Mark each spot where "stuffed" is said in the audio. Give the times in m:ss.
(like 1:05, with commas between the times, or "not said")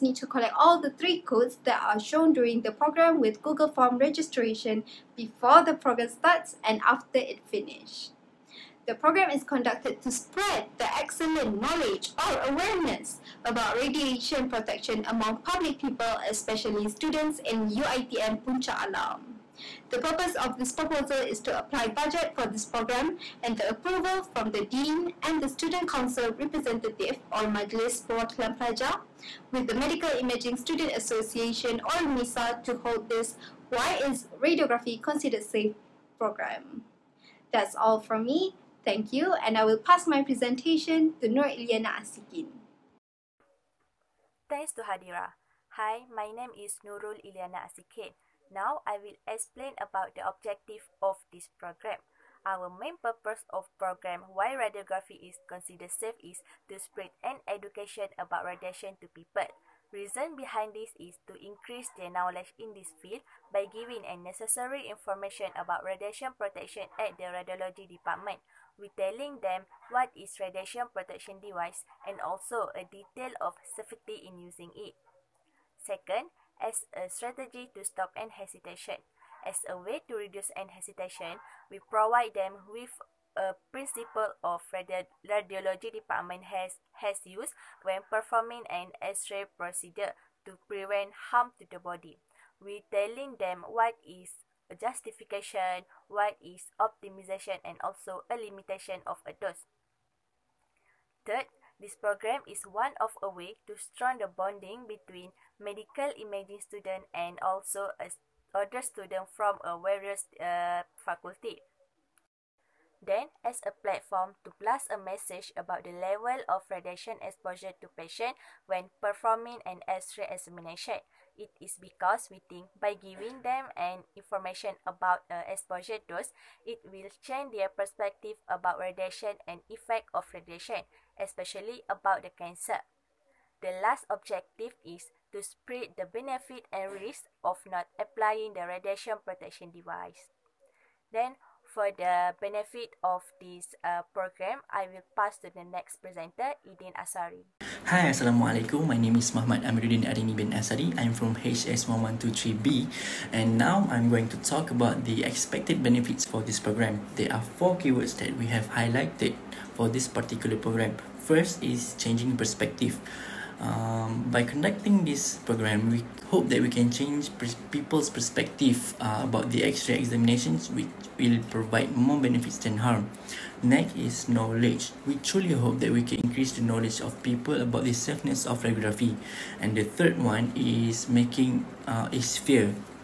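not said.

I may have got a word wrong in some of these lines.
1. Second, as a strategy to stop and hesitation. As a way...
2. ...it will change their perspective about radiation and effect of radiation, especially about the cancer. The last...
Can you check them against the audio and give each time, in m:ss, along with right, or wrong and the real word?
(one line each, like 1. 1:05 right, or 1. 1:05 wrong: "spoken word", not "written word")
1. 1:15 right
2. 2:06 right.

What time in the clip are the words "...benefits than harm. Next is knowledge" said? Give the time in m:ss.
2:52.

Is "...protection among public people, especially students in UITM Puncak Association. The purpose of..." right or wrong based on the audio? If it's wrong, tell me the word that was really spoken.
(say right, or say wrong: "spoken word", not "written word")
wrong: "Alam", not "Association".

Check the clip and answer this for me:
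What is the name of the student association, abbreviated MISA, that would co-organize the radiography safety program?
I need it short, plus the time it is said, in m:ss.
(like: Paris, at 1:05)
Medical Imaging Student Association, at 0:29.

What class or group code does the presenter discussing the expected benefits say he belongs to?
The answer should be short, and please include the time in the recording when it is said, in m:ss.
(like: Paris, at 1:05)
HS1123B, at 2:31.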